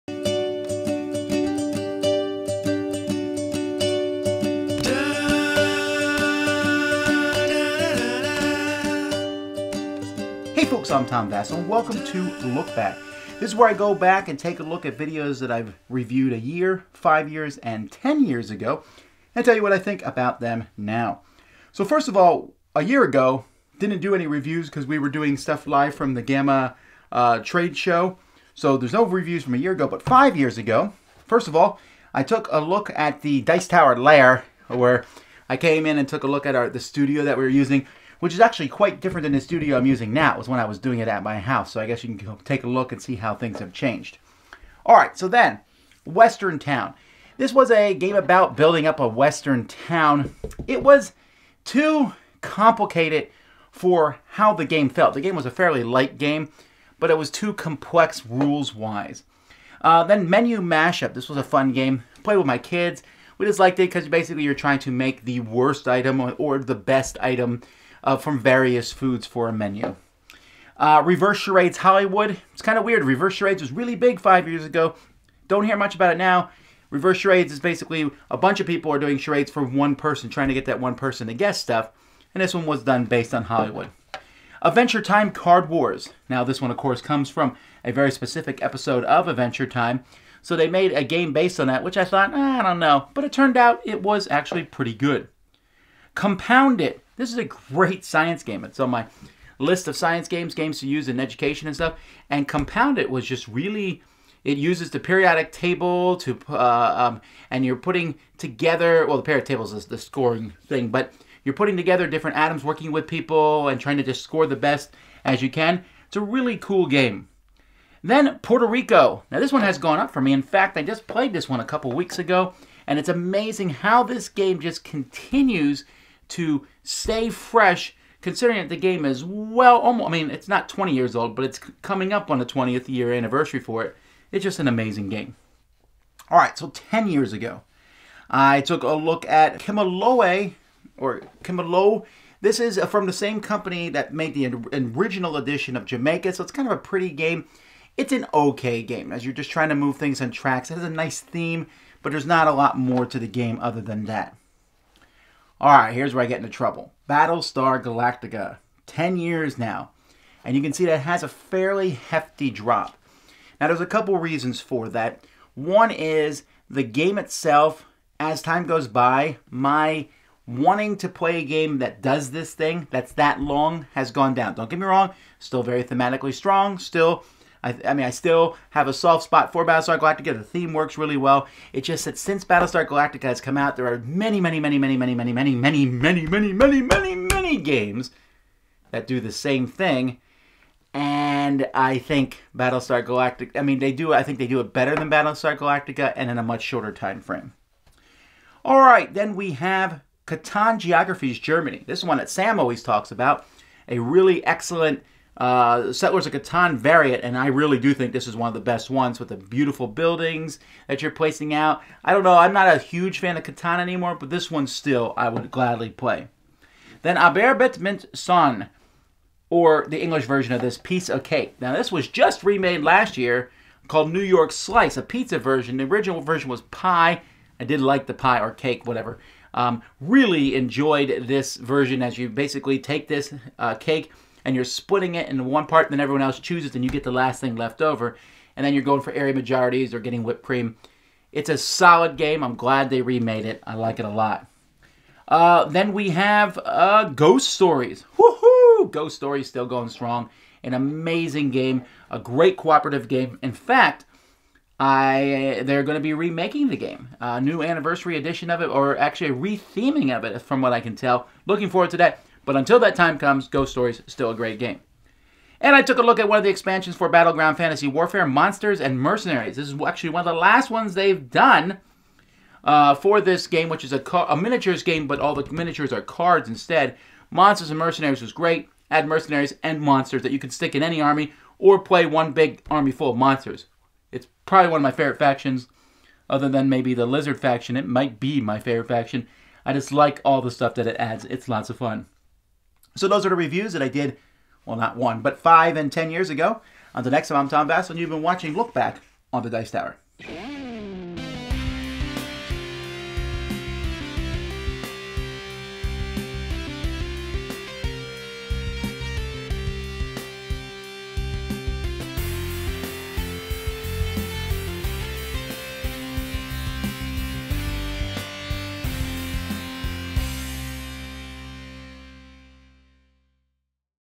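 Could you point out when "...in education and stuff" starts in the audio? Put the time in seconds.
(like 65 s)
101 s.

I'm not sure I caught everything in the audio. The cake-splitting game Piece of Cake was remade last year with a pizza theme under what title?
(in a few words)
New York Slice.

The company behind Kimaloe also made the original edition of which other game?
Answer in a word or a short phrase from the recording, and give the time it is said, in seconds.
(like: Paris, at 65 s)
Jamaica, at 145 s.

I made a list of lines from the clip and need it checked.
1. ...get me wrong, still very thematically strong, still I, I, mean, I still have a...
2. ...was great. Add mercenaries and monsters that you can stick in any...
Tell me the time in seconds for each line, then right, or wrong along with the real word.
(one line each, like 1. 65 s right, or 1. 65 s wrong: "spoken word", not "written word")
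1. 174 s right
2. 278 s right.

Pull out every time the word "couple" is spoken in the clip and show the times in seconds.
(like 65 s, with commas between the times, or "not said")
121 s, 163 s.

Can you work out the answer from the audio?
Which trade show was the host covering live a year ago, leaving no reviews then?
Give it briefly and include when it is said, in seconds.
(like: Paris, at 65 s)
GAMA, at 26 s.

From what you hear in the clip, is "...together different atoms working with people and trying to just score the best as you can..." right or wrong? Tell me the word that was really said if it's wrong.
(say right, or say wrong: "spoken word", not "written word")
right.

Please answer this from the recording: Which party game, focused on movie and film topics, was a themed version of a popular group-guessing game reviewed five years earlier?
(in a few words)
Reverse Charades Hollywood.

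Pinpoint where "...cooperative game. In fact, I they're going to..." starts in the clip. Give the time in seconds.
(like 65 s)
252 s.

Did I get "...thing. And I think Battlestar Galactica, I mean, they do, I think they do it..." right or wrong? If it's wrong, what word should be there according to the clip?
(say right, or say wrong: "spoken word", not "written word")
right.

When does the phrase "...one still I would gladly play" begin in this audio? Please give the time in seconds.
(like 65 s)
214 s.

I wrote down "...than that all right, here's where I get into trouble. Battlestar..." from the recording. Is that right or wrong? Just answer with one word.
right.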